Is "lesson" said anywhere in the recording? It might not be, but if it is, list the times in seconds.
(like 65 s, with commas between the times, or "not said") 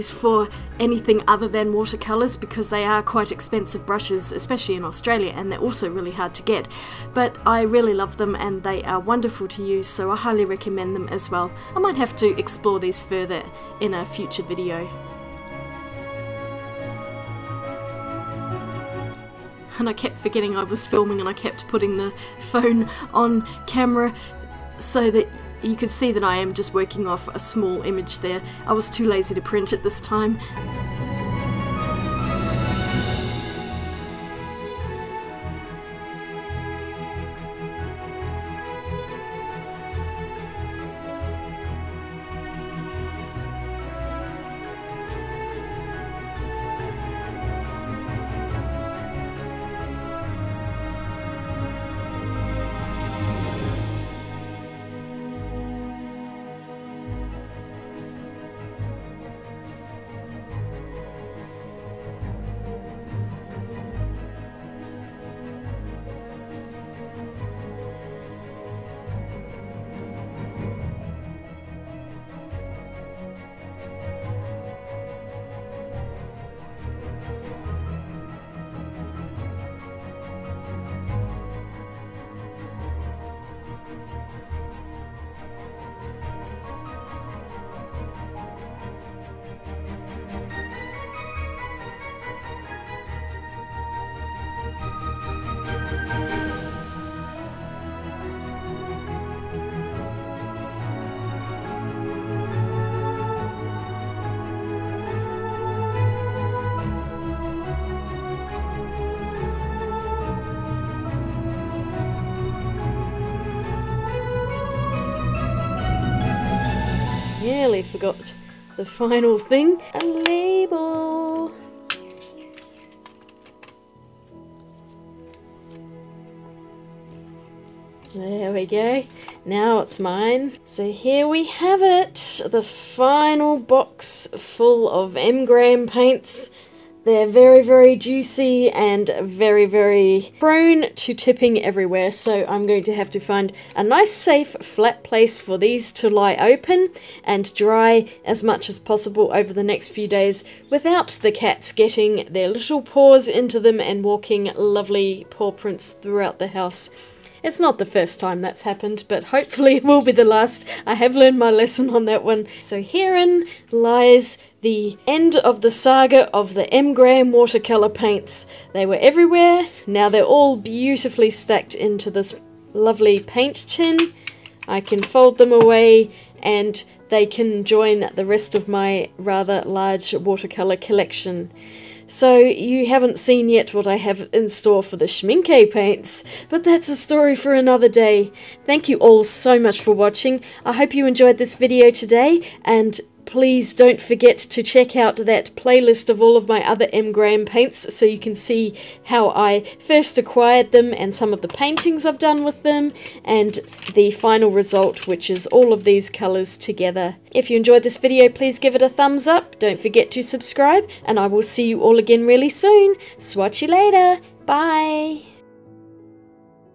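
161 s.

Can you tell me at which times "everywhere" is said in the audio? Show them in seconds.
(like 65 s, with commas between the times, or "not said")
141 s, 168 s.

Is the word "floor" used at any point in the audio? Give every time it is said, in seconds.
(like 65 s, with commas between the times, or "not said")
not said.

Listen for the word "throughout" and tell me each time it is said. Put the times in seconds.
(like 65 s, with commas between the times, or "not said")
155 s.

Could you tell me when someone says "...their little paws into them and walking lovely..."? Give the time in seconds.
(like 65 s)
152 s.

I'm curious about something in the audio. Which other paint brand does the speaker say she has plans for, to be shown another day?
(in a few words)
Schminke.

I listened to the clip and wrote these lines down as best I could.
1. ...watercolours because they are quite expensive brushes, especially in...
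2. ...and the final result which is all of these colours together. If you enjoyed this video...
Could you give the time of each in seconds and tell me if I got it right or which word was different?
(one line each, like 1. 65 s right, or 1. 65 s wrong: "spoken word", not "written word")
1. 1 s right
2. 203 s right.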